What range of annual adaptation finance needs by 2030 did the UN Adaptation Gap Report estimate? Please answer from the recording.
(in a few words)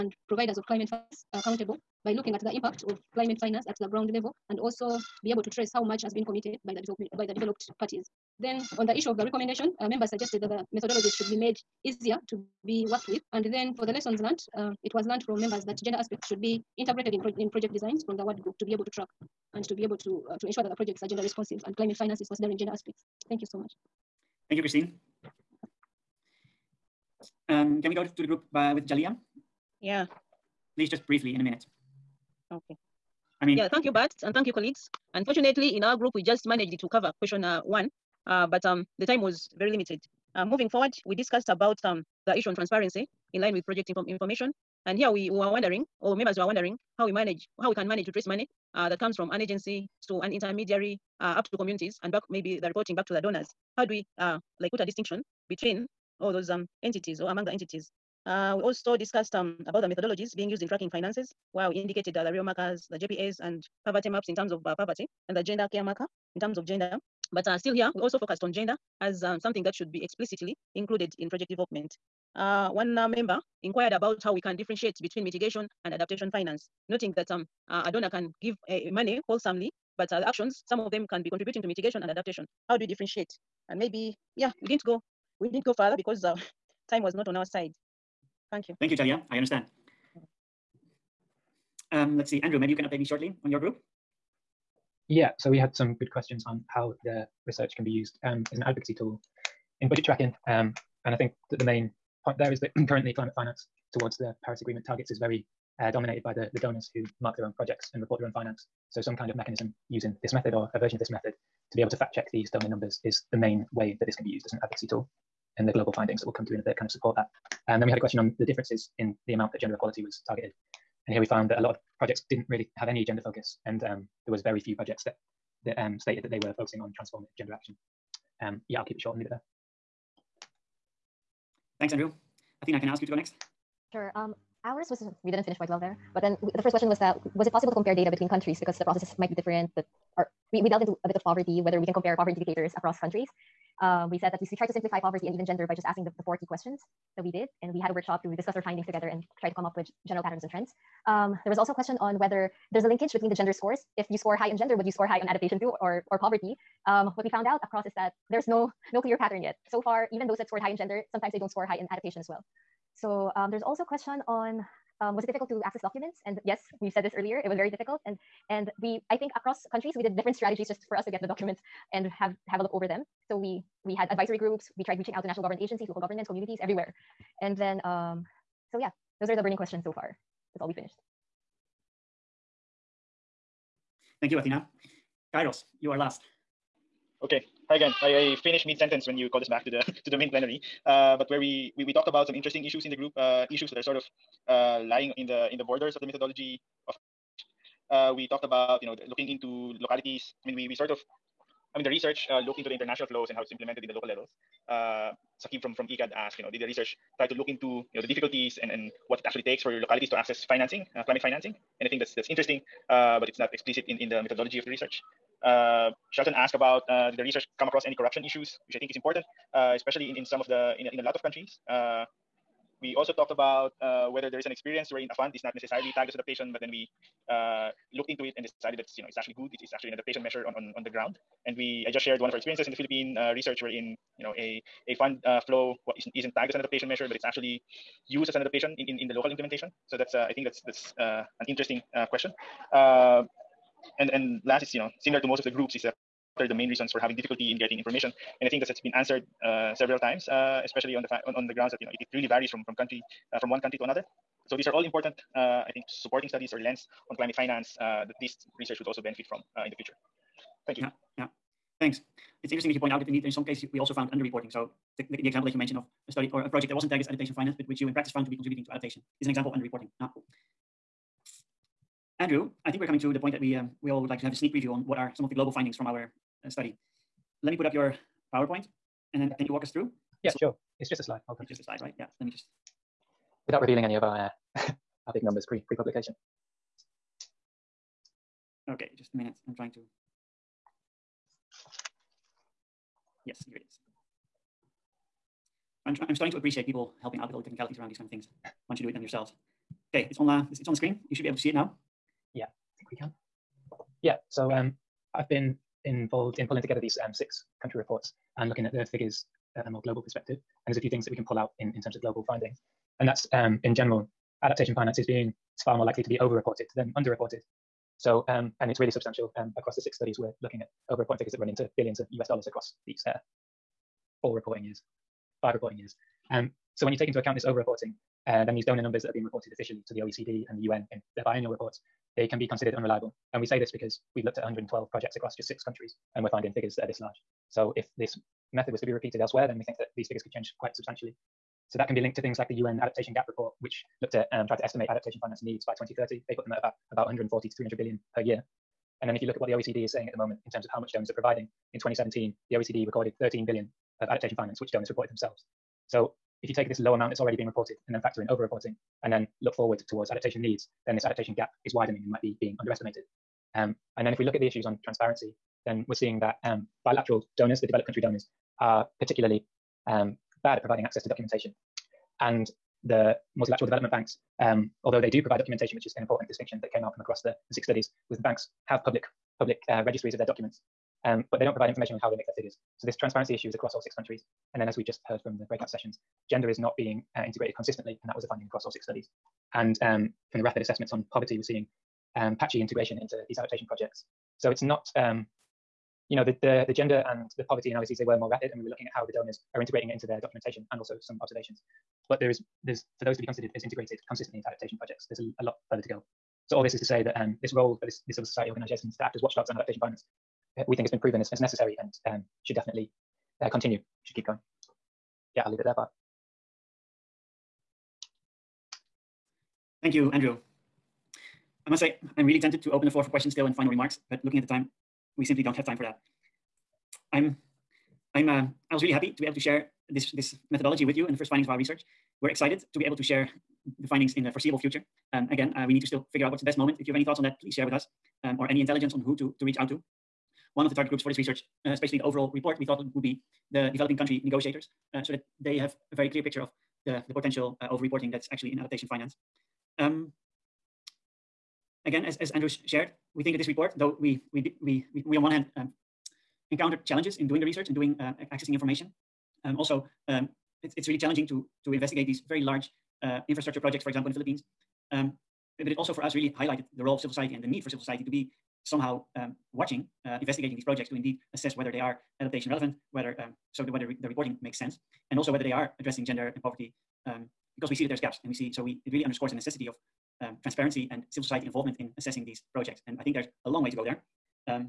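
140 to 300 billion.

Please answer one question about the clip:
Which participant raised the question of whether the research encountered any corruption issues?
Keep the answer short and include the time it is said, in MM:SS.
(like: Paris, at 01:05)
Shelton, at 03:36.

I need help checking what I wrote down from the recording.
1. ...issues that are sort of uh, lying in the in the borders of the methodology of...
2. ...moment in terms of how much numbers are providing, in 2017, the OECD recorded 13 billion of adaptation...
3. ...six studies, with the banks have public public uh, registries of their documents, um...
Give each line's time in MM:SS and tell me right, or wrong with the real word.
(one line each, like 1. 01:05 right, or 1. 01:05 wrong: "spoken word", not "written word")
1. 03:13 right
2. 05:50 wrong: "donors", not "numbers"
3. 06:17 right.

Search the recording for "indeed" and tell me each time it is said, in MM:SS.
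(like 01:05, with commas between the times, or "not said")
04:23, 07:50.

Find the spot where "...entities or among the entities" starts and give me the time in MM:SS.
00:56.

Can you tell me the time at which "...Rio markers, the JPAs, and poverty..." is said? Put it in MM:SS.
01:02.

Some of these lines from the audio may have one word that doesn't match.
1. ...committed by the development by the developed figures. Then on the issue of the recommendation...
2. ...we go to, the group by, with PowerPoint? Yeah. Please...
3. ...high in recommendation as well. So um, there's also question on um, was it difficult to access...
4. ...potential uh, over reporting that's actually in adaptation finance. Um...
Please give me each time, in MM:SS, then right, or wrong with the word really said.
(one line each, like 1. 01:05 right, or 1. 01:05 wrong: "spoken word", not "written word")
1. 00:06 wrong: "parties", not "figures"
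2. 00:27 wrong: "Jalia", not "PowerPoint"
3. 02:41 wrong: "adaptation", not "recommendation"
4. 07:27 right.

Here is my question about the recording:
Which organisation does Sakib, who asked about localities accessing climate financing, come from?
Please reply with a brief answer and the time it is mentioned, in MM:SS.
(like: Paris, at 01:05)
ECAD, at 03:25.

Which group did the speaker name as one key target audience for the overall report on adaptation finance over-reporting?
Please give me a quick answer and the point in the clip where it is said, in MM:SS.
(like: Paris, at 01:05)
developing country negotiators, at 07:23.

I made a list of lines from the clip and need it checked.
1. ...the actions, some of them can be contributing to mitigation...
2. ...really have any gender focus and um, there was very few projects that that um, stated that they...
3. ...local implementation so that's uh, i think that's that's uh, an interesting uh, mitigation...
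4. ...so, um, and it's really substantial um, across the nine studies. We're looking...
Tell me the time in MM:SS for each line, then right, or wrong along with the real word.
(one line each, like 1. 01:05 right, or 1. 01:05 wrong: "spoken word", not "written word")
1. 01:20 right
2. 02:02 right
3. 03:59 wrong: "question", not "mitigation"
4. 05:18 wrong: "six", not "nine".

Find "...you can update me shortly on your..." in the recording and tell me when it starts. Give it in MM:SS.
01:32.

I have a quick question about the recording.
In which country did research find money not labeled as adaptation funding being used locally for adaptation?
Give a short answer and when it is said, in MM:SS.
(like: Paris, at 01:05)
Philippines, at 03:52.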